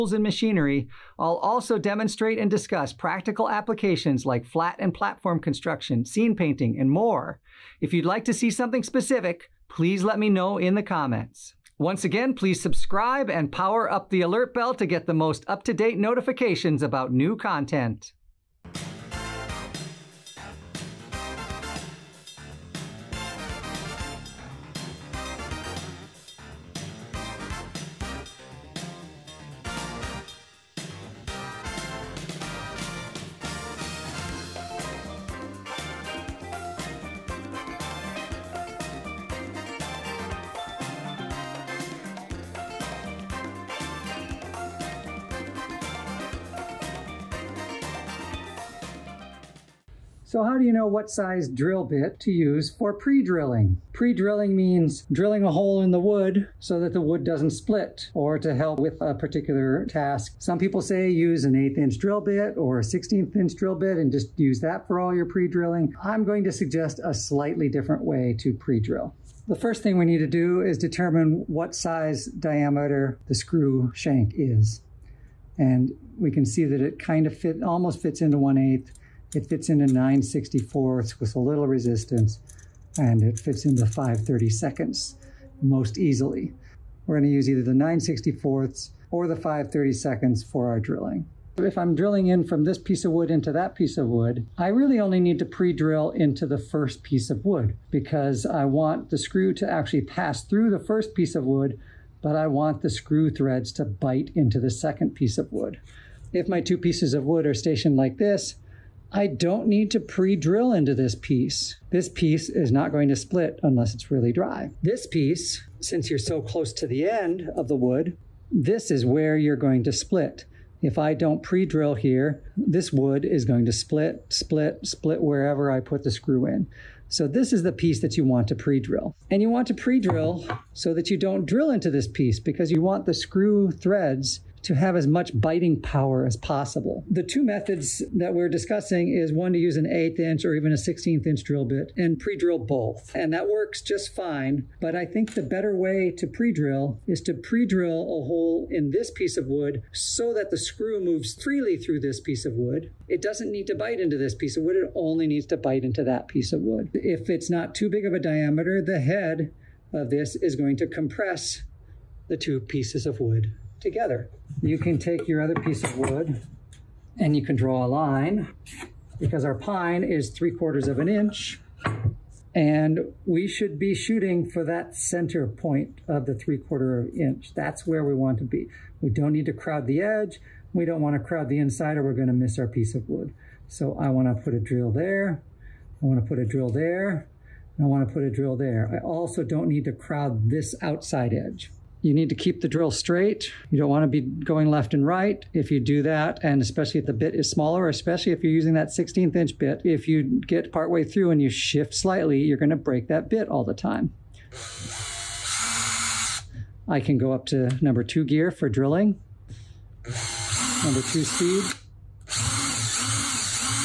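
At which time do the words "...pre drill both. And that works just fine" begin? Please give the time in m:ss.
2:22.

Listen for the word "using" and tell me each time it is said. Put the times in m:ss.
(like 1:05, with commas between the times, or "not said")
3:18.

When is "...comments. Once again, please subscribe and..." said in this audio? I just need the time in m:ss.
0:10.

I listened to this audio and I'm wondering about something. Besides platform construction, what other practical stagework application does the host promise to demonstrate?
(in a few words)
Scene painting.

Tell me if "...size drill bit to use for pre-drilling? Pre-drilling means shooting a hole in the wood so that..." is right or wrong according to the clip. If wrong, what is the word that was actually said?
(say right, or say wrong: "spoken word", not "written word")
wrong: "drilling", not "shooting".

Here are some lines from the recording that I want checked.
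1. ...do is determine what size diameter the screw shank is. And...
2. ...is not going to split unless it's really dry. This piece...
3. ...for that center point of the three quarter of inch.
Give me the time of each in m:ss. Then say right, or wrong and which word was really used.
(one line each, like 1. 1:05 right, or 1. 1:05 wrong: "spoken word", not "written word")
1. 1:10 right
2. 1:52 right
3. 2:54 right.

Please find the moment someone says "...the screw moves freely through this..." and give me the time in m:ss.
2:30.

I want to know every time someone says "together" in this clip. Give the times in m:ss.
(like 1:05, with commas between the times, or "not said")
2:43.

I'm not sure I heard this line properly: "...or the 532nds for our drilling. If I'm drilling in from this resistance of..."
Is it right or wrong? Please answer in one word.
wrong.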